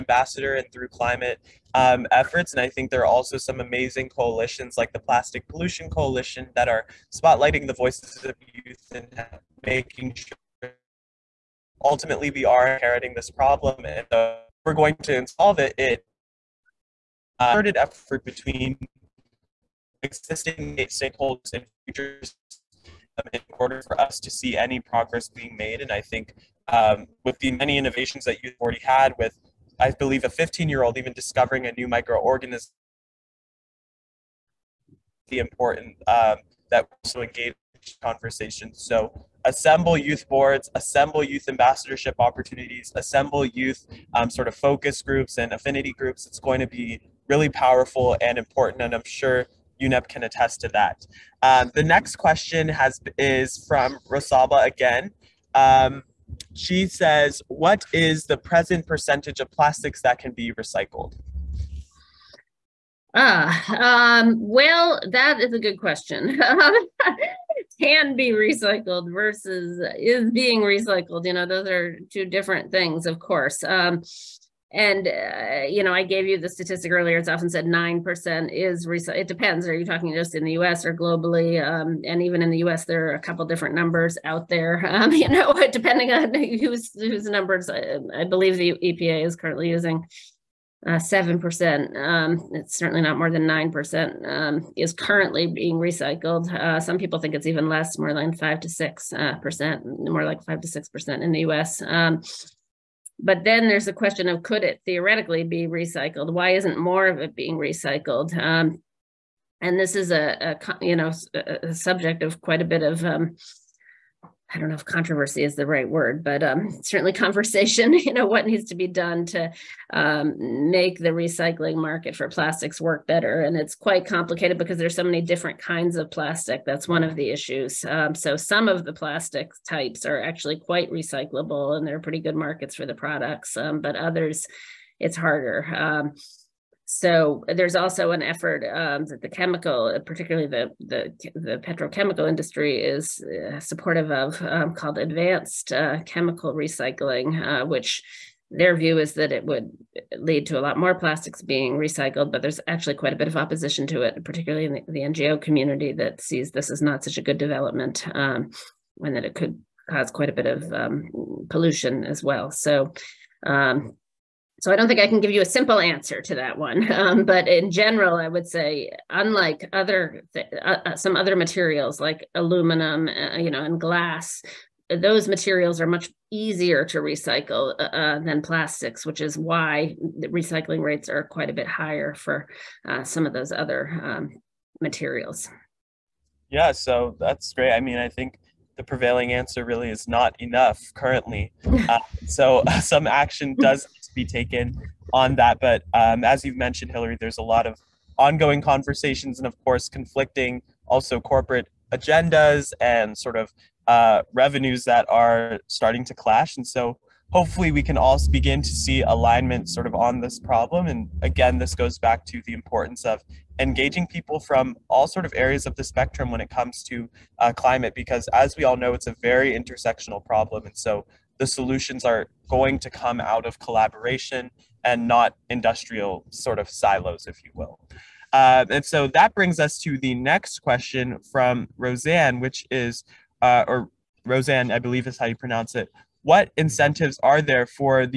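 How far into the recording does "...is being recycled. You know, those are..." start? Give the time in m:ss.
1:09.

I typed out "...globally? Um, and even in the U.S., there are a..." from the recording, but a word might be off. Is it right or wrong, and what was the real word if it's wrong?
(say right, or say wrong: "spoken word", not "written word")
right.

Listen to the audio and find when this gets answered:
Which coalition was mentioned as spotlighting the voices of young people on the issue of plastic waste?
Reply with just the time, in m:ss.
0:04.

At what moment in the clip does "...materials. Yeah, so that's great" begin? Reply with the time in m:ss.
3:04.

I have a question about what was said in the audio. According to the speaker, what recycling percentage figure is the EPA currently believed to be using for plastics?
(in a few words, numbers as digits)
7 percent.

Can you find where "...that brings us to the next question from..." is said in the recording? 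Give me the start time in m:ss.
3:49.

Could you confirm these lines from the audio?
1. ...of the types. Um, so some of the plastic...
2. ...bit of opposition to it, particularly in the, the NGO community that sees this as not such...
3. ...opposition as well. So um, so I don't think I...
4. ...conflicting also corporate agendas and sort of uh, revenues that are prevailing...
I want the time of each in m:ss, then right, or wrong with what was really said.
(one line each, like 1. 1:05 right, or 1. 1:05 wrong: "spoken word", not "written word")
1. 2:07 wrong: "issues", not "types"
2. 2:33 right
3. 2:41 wrong: "pollution", not "opposition"
4. 3:19 wrong: "starting", not "prevailing".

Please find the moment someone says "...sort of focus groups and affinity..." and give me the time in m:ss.
0:44.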